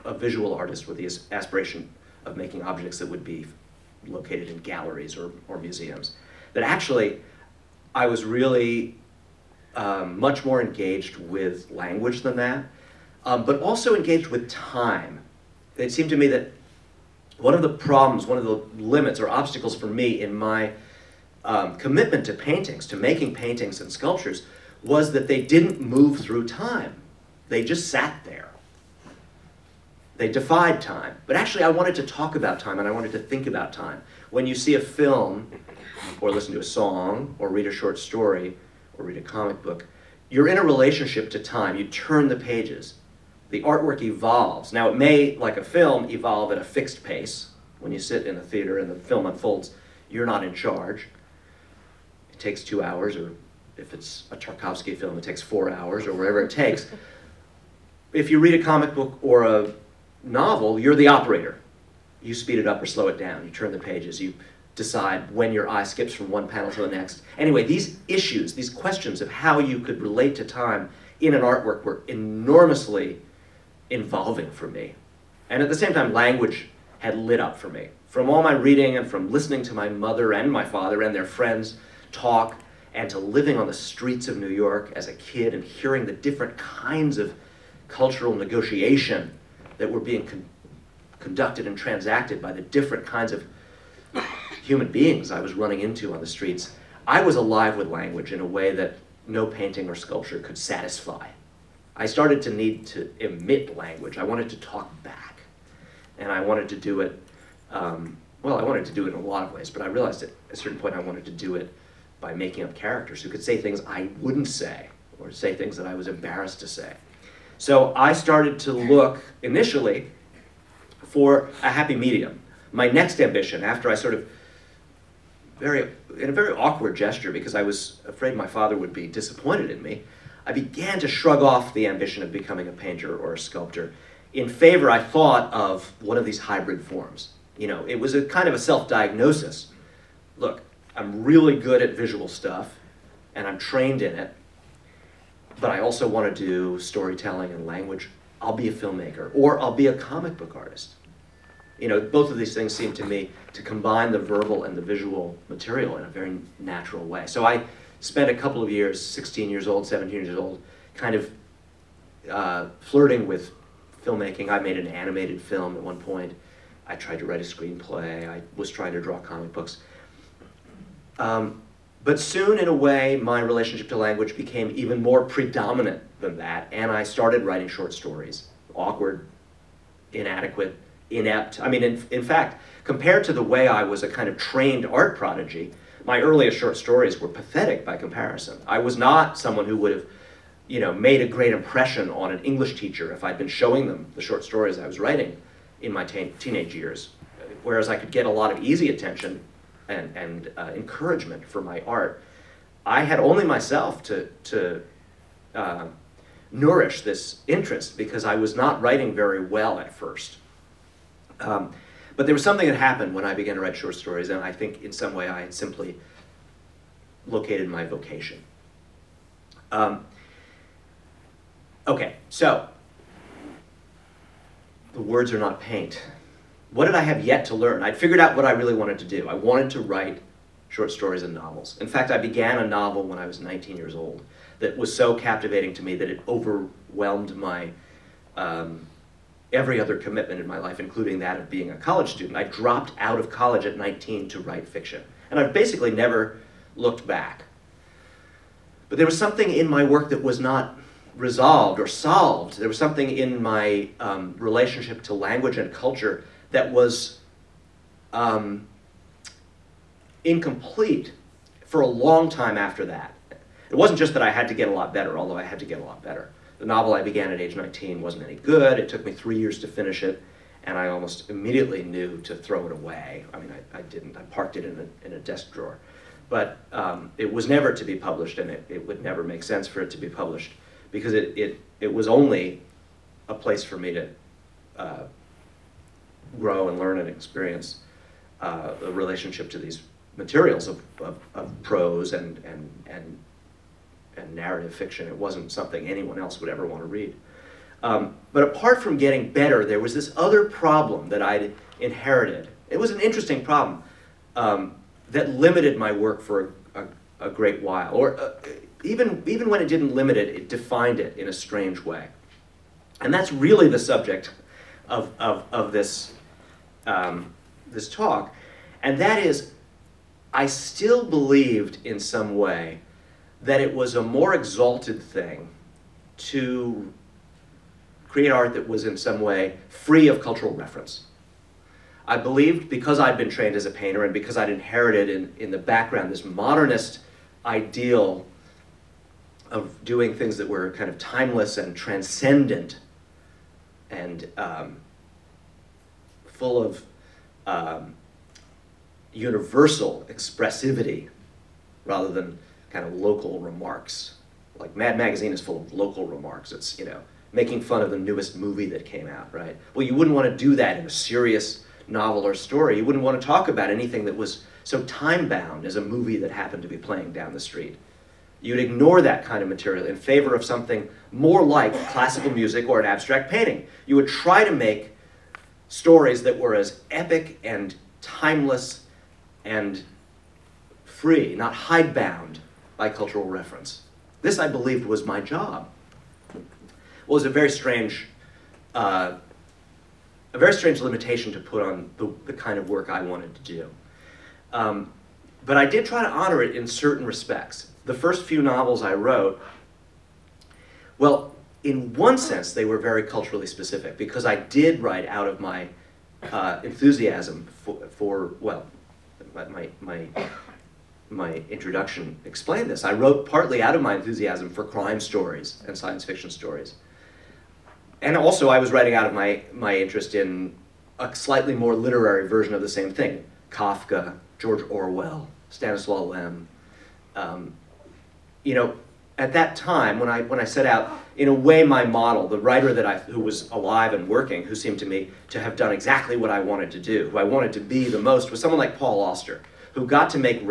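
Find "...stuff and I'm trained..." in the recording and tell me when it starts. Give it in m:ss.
2:22.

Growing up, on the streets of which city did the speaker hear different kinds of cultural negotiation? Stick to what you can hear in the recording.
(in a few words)
New York.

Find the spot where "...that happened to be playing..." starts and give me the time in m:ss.
6:06.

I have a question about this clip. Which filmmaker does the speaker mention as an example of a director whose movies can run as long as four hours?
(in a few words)
Tarkovsky.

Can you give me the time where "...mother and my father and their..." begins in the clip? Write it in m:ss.
1:19.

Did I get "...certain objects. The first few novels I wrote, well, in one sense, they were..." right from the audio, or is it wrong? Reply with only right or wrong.
wrong.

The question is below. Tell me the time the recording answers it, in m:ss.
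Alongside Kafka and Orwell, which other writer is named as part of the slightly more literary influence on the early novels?
7:05.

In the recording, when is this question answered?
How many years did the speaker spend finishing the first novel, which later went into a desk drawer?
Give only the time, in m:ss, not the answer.
4:29.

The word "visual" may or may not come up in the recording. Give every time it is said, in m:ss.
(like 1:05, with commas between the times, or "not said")
0:00, 2:21, 2:34.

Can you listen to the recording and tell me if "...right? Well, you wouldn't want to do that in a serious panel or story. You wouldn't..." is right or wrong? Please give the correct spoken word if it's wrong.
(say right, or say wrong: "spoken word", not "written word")
wrong: "novel", not "panel".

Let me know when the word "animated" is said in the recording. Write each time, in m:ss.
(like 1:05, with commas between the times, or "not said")
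2:44.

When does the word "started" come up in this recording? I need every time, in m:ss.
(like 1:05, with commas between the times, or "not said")
1:42, 1:58, 2:57.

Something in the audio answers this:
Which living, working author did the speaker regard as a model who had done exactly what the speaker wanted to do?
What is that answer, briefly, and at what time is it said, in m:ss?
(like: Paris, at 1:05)
Paul Auster, at 7:18.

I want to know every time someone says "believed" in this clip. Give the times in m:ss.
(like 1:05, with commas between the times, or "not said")
5:21, 5:32, 6:24.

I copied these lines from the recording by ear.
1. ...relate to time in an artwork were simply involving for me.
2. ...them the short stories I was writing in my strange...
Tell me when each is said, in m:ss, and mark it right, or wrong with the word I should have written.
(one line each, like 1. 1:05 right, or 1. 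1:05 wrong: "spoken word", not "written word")
1. 1:10 wrong: "enormously", not "simply"
2. 3:13 wrong: "teenage", not "strange".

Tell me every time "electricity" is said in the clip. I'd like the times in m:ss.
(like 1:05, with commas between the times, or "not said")
not said.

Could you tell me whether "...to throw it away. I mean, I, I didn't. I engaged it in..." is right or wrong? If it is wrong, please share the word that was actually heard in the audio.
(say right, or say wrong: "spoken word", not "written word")
wrong: "parked", not "engaged".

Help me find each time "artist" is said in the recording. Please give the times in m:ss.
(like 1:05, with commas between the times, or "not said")
0:00, 2:30.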